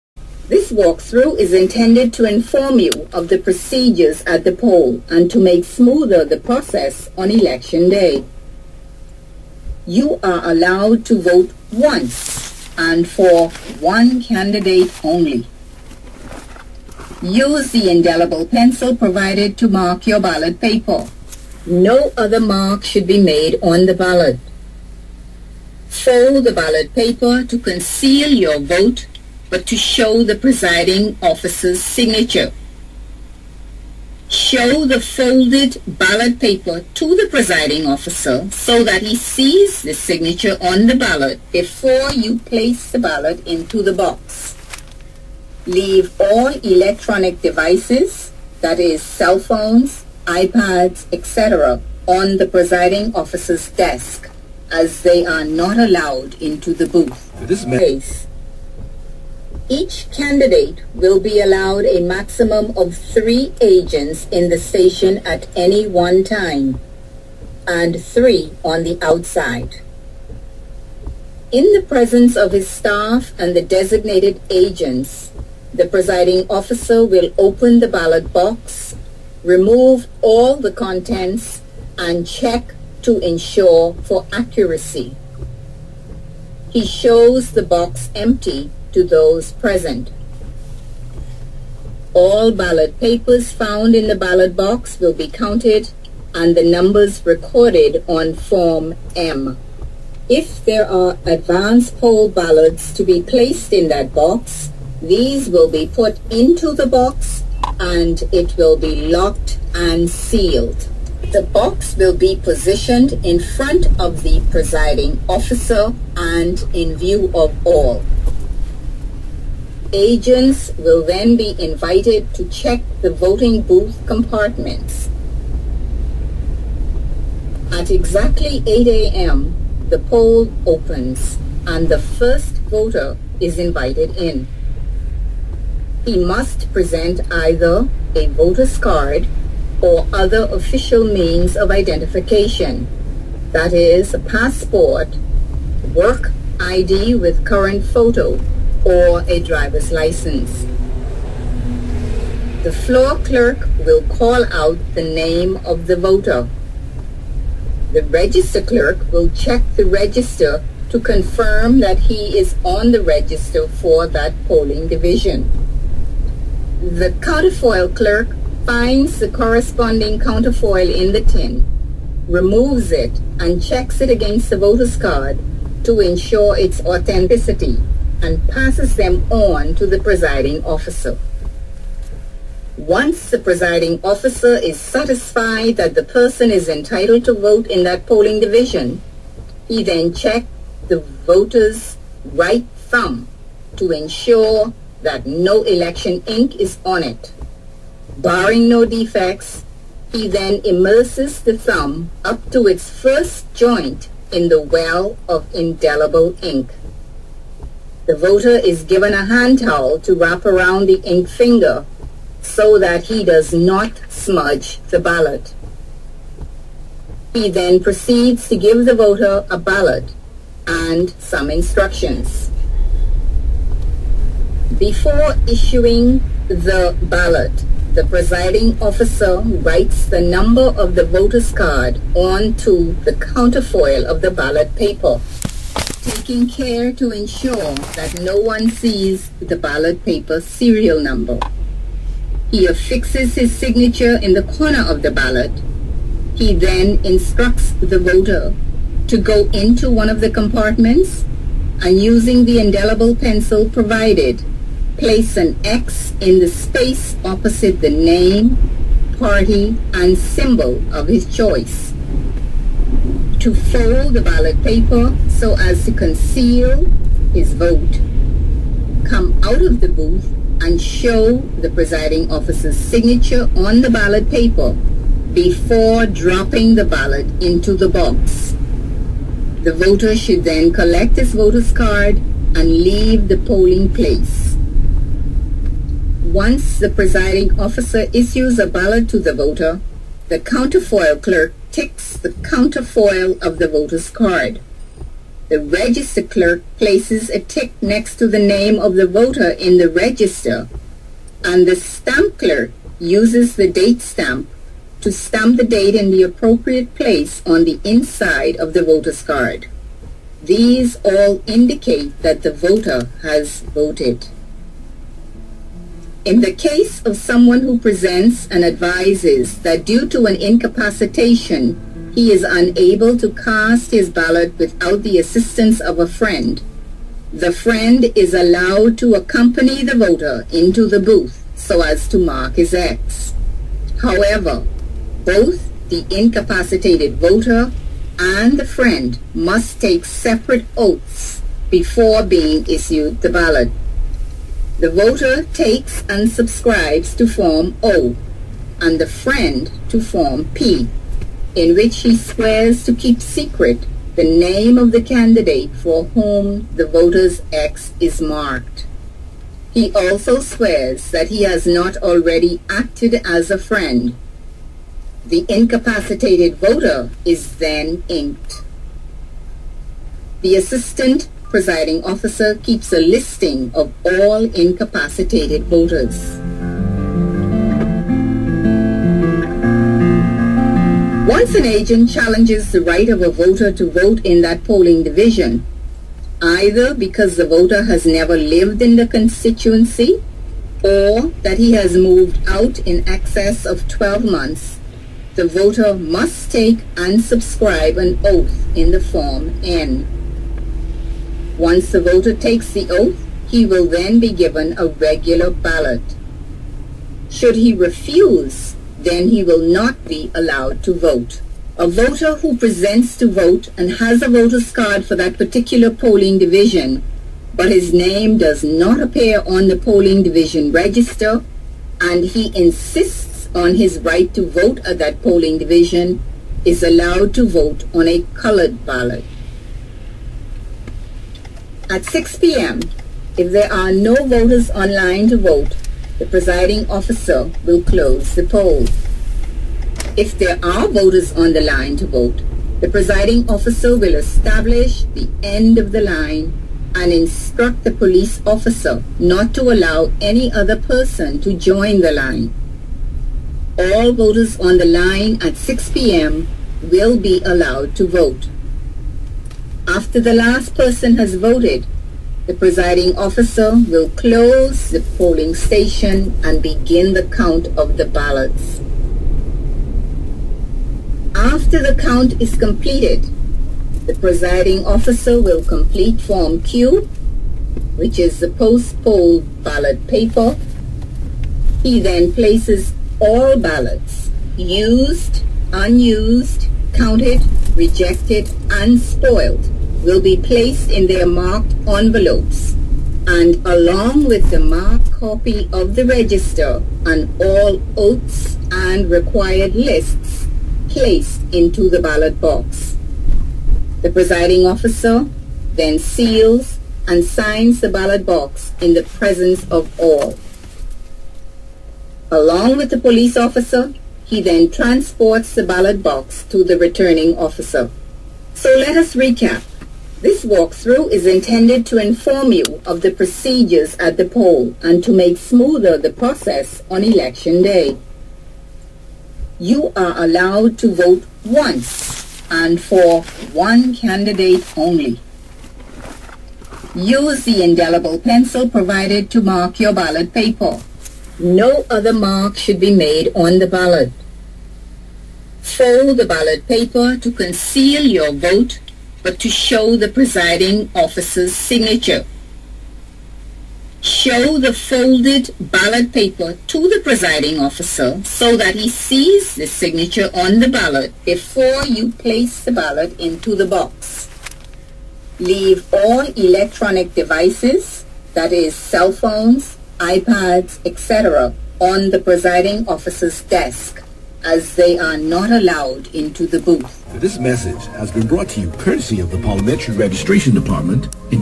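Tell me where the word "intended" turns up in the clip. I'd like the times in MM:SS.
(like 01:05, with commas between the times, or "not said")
00:01, 08:41.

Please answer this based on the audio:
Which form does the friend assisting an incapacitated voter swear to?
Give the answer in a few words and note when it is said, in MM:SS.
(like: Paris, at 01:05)
Form P, at 05:50.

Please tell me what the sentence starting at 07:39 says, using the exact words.
After the last person has voted, the presiding officer will close the polling station and begin the count of the ballots.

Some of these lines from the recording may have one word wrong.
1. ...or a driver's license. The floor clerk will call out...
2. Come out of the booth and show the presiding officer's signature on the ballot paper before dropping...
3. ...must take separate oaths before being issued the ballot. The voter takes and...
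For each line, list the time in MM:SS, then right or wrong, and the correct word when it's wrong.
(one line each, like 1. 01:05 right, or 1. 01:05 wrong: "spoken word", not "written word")
1. 02:28 right
2. 04:29 right
3. 05:39 right.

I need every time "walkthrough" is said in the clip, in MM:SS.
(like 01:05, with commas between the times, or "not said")
00:00, 08:40.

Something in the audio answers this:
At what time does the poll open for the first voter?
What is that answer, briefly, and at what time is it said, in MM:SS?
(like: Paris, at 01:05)
8 a.m., at 02:08.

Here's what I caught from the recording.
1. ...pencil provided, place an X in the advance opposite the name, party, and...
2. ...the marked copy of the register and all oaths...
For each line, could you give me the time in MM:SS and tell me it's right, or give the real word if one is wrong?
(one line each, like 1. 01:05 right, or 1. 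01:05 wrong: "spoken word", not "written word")
1. 04:13 wrong: "space", not "advance"
2. 08:14 right.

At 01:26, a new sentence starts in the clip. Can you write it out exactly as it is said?
He shows the box empty to those present.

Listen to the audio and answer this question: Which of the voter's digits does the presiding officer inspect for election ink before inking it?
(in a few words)
Right thumb.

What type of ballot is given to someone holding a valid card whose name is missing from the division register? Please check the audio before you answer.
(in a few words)
Colored ballot.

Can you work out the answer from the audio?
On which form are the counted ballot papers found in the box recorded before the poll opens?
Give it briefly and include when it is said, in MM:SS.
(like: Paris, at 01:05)
Form M, at 01:38.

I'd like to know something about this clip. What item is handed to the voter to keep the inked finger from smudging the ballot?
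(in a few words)
Hand towel.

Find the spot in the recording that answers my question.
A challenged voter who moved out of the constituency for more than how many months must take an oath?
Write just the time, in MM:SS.
06:33.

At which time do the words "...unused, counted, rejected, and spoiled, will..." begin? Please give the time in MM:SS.
08:05.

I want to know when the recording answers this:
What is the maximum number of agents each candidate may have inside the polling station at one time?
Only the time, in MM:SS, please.
01:02.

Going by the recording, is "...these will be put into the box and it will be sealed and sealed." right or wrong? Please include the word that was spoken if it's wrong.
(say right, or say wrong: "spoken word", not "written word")
wrong: "locked", not "sealed".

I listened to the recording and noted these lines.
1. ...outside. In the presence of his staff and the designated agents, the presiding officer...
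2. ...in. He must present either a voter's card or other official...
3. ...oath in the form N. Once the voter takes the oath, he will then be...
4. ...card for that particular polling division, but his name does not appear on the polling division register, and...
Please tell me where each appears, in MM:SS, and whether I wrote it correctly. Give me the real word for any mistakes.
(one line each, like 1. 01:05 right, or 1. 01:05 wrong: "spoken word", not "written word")
1. 01:09 right
2. 02:14 right
3. 06:38 right
4. 06:54 right.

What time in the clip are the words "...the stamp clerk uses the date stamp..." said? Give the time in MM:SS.
05:01.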